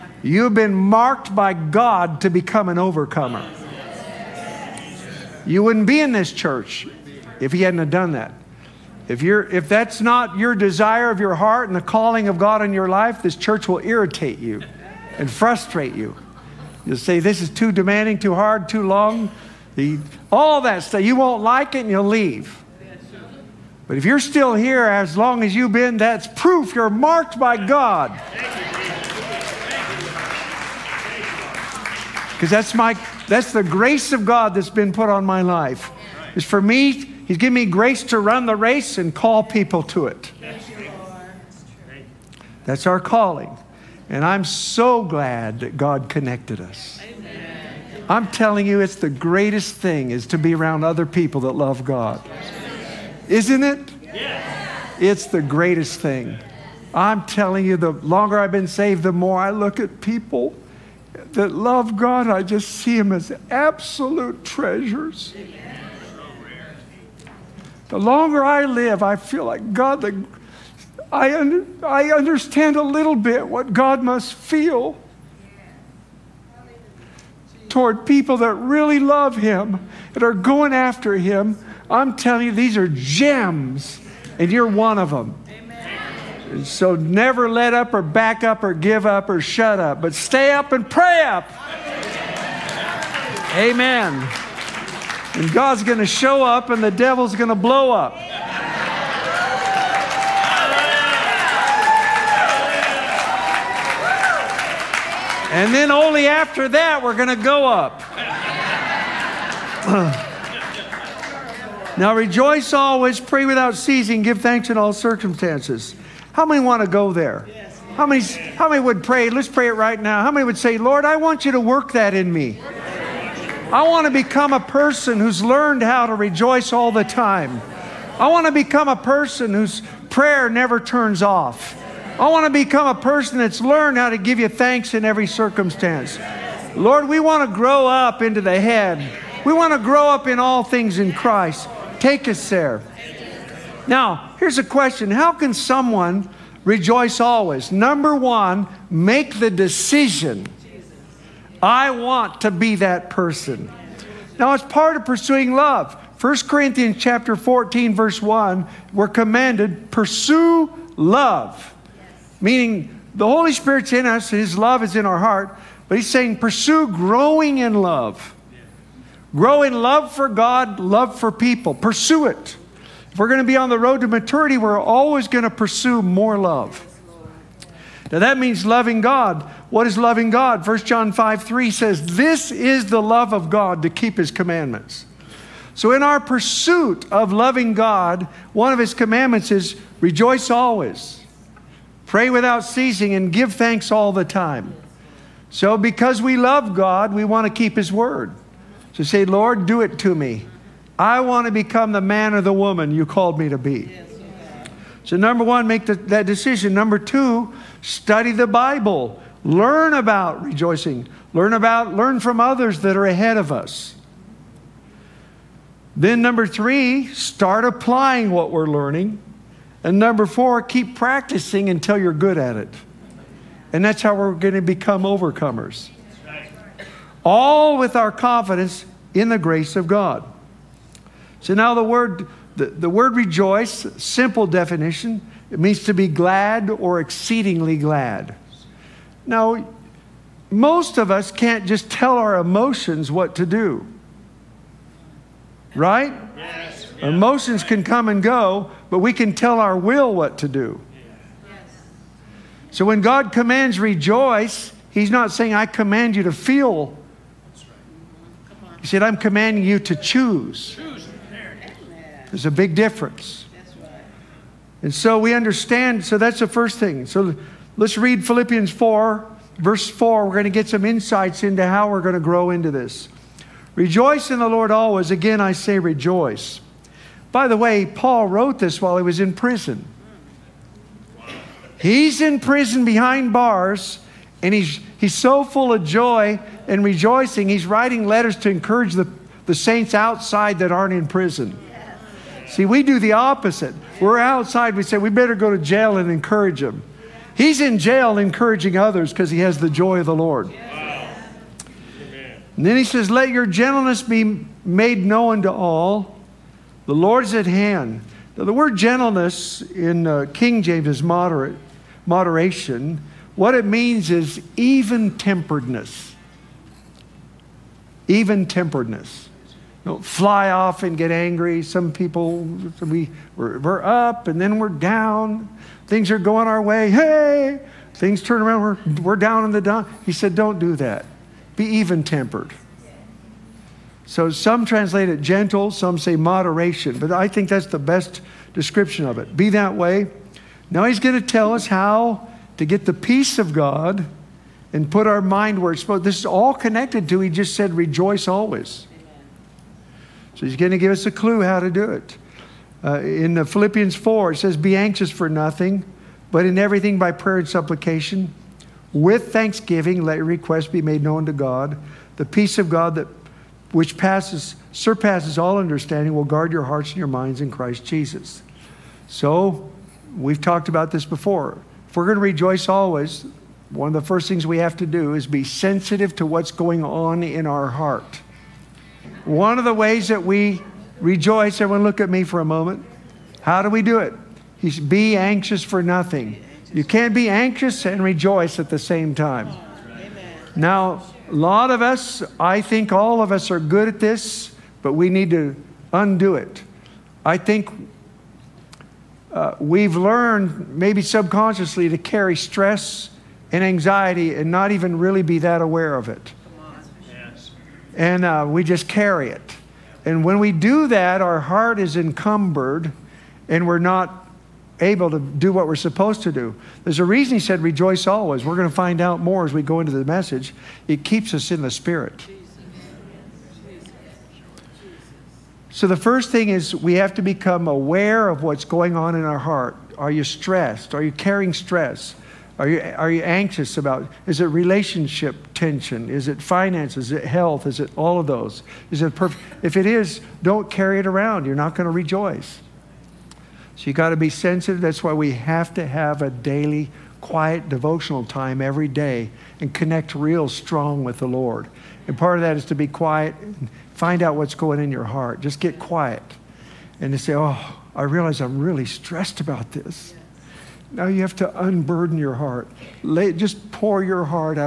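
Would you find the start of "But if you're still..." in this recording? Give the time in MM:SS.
00:23.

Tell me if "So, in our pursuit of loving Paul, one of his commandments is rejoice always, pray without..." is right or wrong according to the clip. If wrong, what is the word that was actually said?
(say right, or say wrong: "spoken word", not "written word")
wrong: "God", not "Paul".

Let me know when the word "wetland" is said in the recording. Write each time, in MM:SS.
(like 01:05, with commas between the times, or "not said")
not said.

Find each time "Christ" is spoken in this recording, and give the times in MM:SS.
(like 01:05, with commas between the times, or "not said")
02:21, 06:07.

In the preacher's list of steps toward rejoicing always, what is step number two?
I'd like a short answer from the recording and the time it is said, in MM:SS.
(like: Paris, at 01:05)
Study the Bible, at 03:27.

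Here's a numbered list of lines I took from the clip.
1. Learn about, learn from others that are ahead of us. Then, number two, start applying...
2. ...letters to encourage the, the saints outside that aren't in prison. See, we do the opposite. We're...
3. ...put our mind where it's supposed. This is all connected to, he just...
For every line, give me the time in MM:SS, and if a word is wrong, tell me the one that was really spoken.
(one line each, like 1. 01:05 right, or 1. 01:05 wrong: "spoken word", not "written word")
1. 03:31 wrong: "three", not "two"
2. 04:48 right
3. 05:44 right.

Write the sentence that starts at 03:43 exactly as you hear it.
And that's how we're going to become overcomers all with our confidence in the grace of God.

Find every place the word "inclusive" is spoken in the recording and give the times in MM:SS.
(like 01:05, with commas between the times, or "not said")
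not said.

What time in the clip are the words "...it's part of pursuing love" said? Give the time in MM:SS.
02:34.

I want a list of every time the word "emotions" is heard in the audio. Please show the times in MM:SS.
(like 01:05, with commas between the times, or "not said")
04:02, 04:07.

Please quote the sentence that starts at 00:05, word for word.
You wouldn't be in this church if He hadn't have done that.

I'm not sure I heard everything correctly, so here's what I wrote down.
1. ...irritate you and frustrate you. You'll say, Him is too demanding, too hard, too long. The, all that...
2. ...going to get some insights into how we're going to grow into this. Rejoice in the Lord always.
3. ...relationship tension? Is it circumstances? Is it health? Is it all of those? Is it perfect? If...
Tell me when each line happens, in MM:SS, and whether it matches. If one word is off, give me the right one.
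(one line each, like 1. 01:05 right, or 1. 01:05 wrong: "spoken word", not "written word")
1. 00:13 wrong: "This", not "Him"
2. 04:30 right
3. 07:14 wrong: "finances", not "circumstances".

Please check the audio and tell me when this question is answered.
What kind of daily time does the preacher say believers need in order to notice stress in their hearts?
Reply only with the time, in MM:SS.
07:27.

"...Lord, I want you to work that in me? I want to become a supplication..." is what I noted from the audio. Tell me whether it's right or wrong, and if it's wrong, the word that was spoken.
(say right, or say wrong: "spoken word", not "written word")
wrong: "person", not "supplication".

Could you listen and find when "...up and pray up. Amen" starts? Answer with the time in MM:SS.
01:30.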